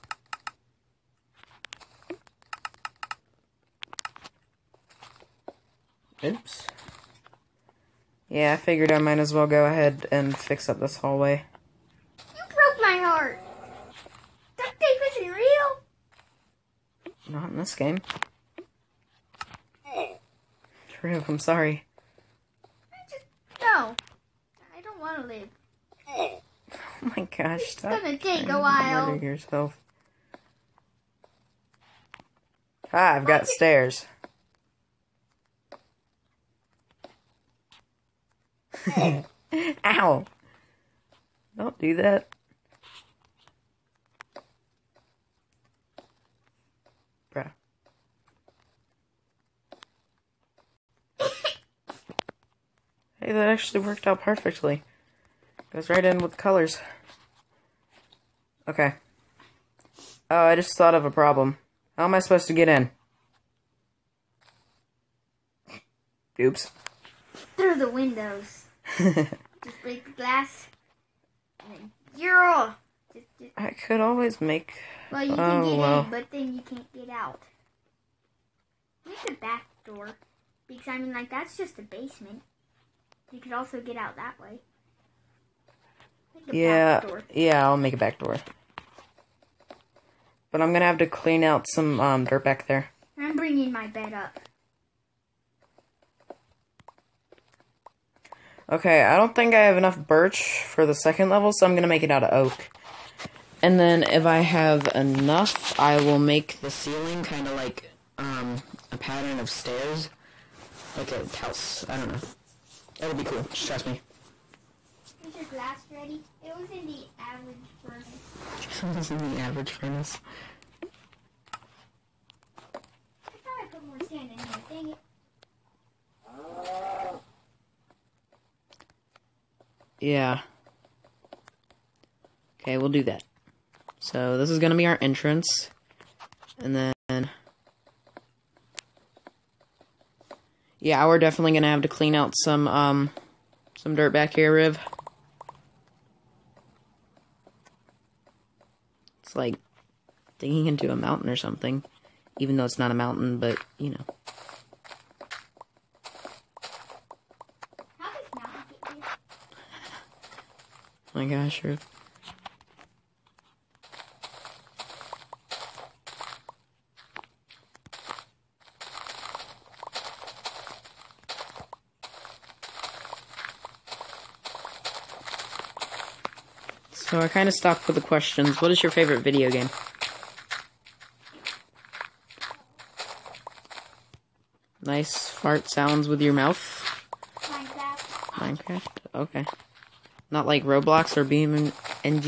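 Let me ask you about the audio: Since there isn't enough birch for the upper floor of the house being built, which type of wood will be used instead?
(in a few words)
Oak.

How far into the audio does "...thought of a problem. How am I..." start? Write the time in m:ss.
1:00.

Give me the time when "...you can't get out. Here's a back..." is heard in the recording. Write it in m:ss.
1:16.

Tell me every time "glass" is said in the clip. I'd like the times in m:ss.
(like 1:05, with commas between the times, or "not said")
1:10, 1:55.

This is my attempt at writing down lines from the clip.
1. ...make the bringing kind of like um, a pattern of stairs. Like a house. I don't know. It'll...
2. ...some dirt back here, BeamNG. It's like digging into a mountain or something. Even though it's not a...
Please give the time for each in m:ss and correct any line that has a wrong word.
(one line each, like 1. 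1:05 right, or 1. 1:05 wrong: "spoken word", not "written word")
1. 1:46 wrong: "ceiling", not "bringing"
2. 2:23 wrong: "Riv", not "BeamNG".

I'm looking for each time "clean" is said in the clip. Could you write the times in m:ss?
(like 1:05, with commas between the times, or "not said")
1:31, 2:21.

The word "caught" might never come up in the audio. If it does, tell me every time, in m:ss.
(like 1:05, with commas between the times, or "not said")
not said.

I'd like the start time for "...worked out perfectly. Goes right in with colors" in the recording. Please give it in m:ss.
0:53.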